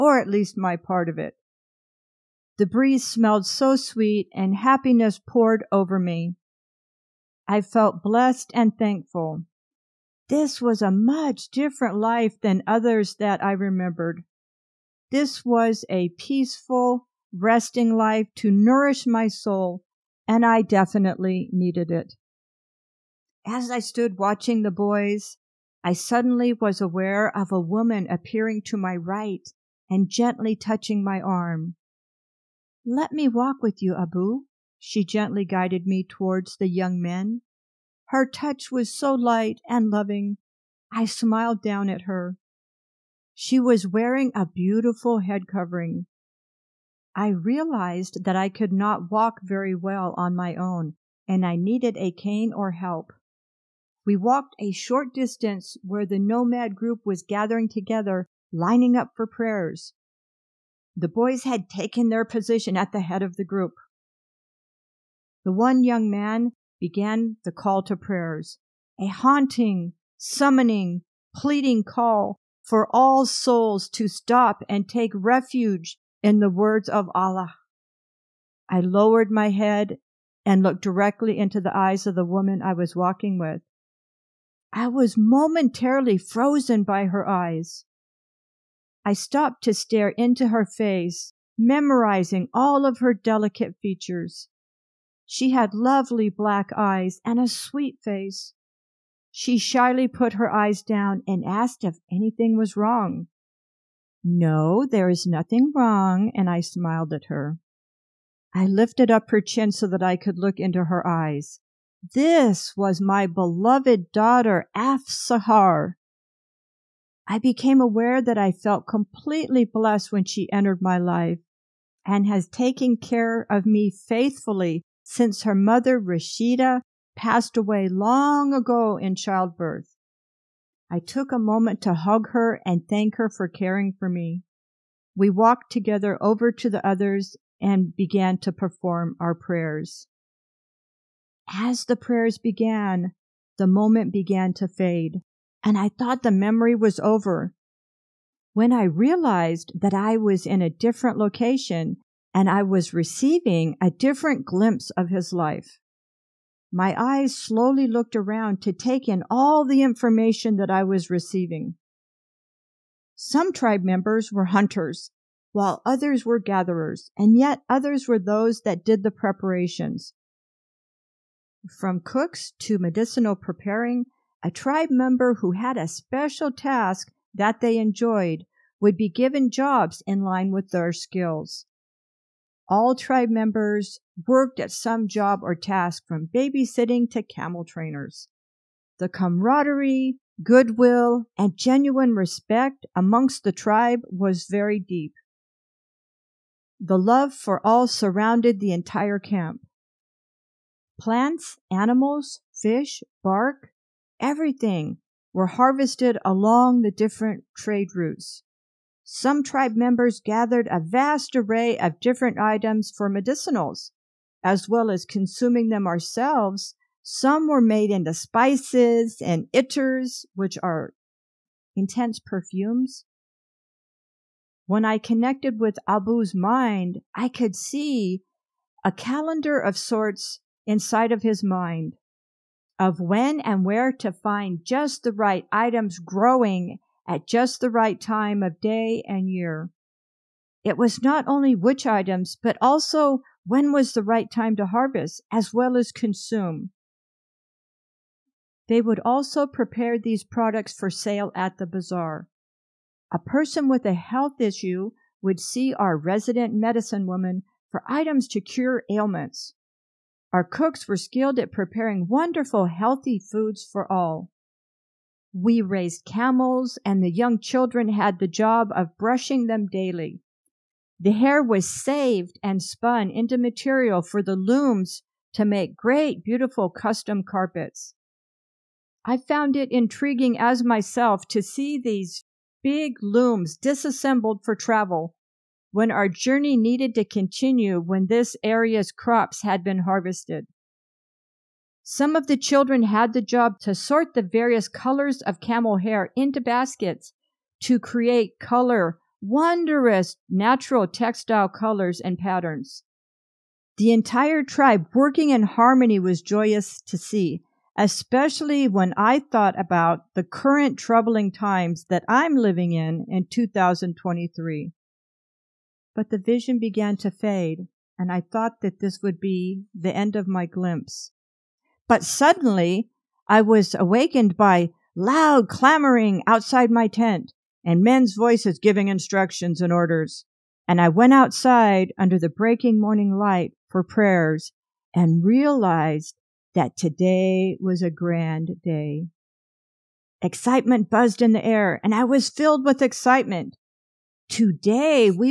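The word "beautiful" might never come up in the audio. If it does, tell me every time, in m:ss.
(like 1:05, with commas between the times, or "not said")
0:44, 4:36.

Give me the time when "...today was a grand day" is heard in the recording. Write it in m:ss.
5:36.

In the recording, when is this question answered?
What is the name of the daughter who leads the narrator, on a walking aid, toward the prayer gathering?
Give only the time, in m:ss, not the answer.
1:54.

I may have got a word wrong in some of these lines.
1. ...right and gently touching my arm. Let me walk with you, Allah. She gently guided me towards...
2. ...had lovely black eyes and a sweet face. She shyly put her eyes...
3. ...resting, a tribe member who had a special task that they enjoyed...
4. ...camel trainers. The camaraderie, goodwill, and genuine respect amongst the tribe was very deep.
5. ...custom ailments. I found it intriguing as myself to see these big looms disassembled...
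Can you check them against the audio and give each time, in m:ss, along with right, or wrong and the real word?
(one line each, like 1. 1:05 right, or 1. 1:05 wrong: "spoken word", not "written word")
1. 0:28 wrong: "Abu", not "Allah"
2. 1:35 right
3. 2:53 wrong: "preparing", not "resting"
4. 3:07 right
5. 4:36 wrong: "carpets", not "ailments".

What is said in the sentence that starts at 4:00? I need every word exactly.
It was not only which items, but also when was the right time to harvest as well as consume.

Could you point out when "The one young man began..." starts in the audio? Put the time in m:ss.
1:05.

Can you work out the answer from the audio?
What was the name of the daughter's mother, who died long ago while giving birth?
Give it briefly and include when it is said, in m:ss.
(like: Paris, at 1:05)
Rashida, at 2:06.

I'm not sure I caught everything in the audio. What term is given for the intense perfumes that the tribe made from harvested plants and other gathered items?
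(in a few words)
ittars.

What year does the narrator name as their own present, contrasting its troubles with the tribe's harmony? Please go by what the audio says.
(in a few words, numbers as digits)
2023.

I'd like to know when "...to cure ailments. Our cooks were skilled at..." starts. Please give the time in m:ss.
4:18.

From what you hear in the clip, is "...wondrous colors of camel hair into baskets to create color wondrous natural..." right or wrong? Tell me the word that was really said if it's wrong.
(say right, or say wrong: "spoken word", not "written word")
wrong: "various", not "wondrous".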